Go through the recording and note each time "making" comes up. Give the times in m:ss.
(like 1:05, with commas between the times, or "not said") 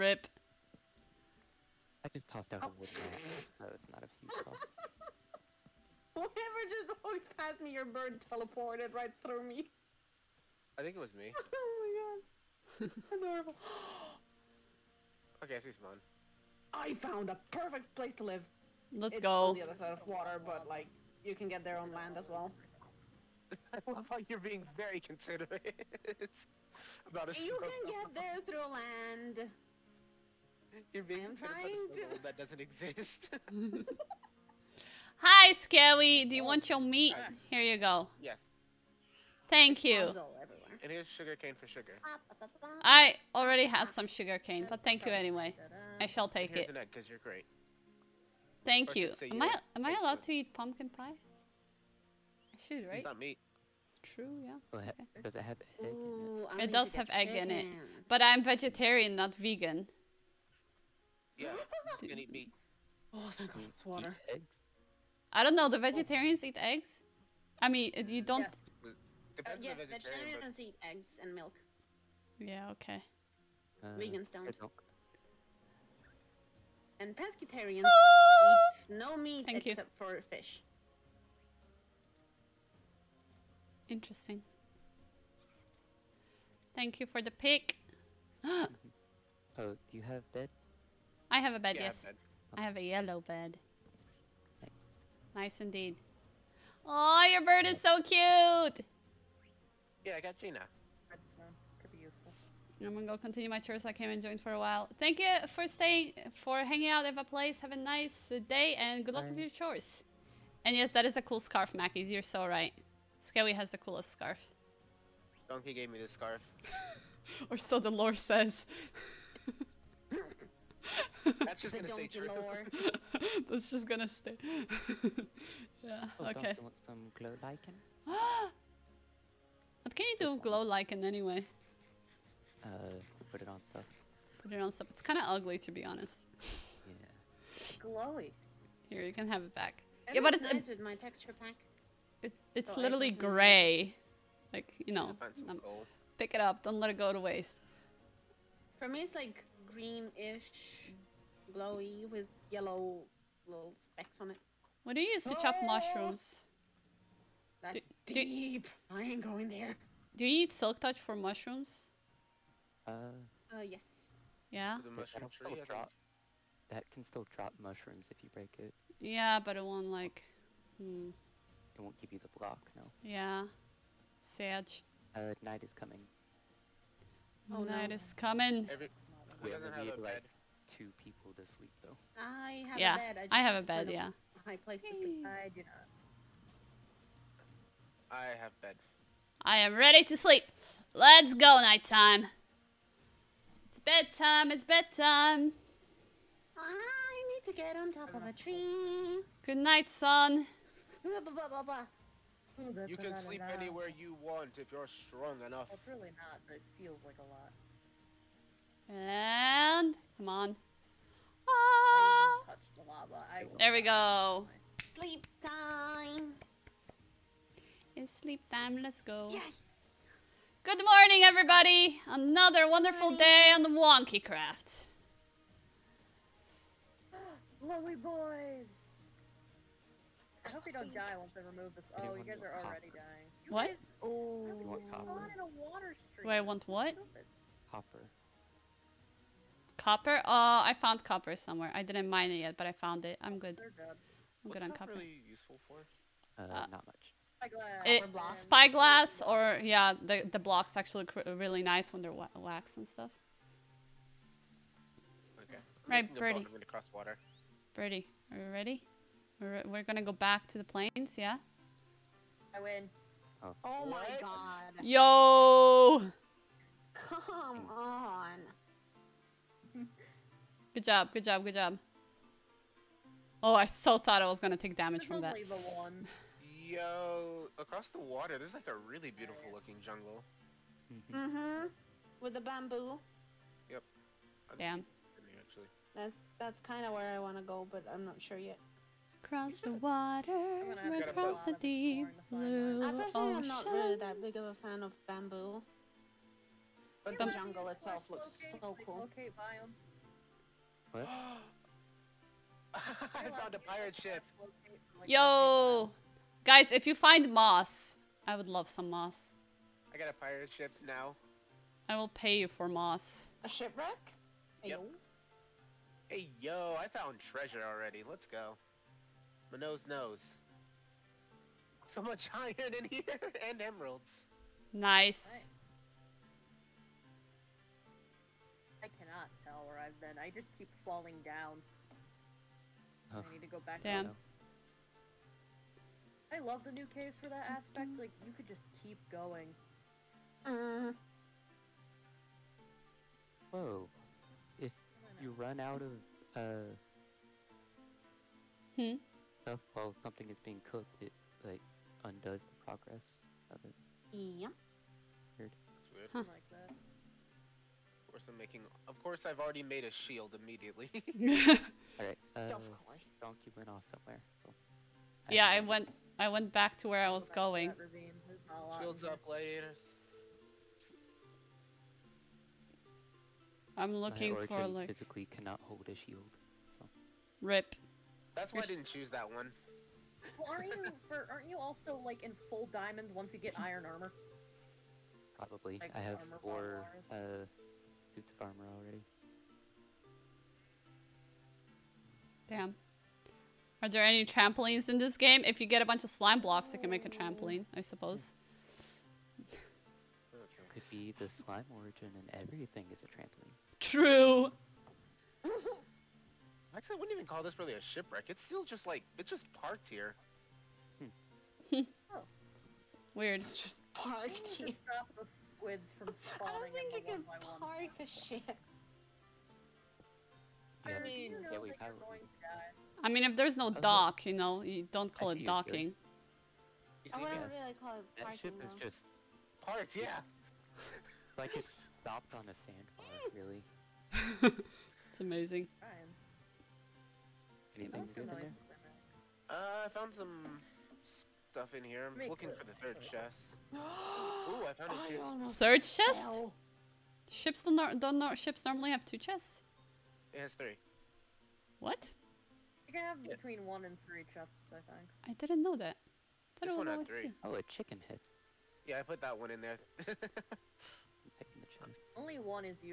5:58.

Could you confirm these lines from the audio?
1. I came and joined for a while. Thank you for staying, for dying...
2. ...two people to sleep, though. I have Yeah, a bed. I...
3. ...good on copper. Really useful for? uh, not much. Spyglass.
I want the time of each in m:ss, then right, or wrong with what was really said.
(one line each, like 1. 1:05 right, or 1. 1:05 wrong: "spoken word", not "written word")
1. 1:43 wrong: "hanging", not "dying"
2. 3:00 right
3. 4:04 right.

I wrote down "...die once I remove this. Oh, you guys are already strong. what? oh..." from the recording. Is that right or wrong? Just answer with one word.
wrong.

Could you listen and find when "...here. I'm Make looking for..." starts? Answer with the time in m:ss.
7:21.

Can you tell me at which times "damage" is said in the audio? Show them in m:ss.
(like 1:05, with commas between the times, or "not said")
4:34.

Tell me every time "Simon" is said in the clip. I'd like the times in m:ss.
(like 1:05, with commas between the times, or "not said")
0:15.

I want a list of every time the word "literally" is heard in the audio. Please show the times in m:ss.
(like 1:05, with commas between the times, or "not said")
2:22.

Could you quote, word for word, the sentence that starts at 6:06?
I went back to where I was going.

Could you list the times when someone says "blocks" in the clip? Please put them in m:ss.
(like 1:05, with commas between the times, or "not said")
2:52, 4:10, 6:36.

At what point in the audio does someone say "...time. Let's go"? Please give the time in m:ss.
3:38.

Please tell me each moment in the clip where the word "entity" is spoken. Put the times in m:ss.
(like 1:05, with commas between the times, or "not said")
not said.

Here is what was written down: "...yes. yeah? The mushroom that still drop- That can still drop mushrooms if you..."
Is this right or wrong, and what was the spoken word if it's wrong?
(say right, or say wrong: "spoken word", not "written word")
right.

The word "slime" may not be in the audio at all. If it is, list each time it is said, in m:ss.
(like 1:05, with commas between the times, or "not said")
6:36, 6:41.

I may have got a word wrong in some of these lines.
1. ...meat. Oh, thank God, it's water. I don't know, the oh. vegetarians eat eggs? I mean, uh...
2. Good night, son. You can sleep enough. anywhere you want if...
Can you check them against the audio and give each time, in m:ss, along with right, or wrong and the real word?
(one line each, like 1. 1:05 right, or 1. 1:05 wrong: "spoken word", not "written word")
1. 1:02 right
2. 3:19 right.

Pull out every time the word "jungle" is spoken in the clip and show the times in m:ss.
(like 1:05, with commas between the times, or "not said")
4:39, 4:57.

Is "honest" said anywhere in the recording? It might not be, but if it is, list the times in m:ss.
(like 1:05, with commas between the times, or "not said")
2:15.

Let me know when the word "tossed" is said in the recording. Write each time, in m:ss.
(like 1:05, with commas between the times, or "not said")
0:02.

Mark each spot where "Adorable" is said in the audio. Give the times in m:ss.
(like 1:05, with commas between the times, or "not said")
0:13.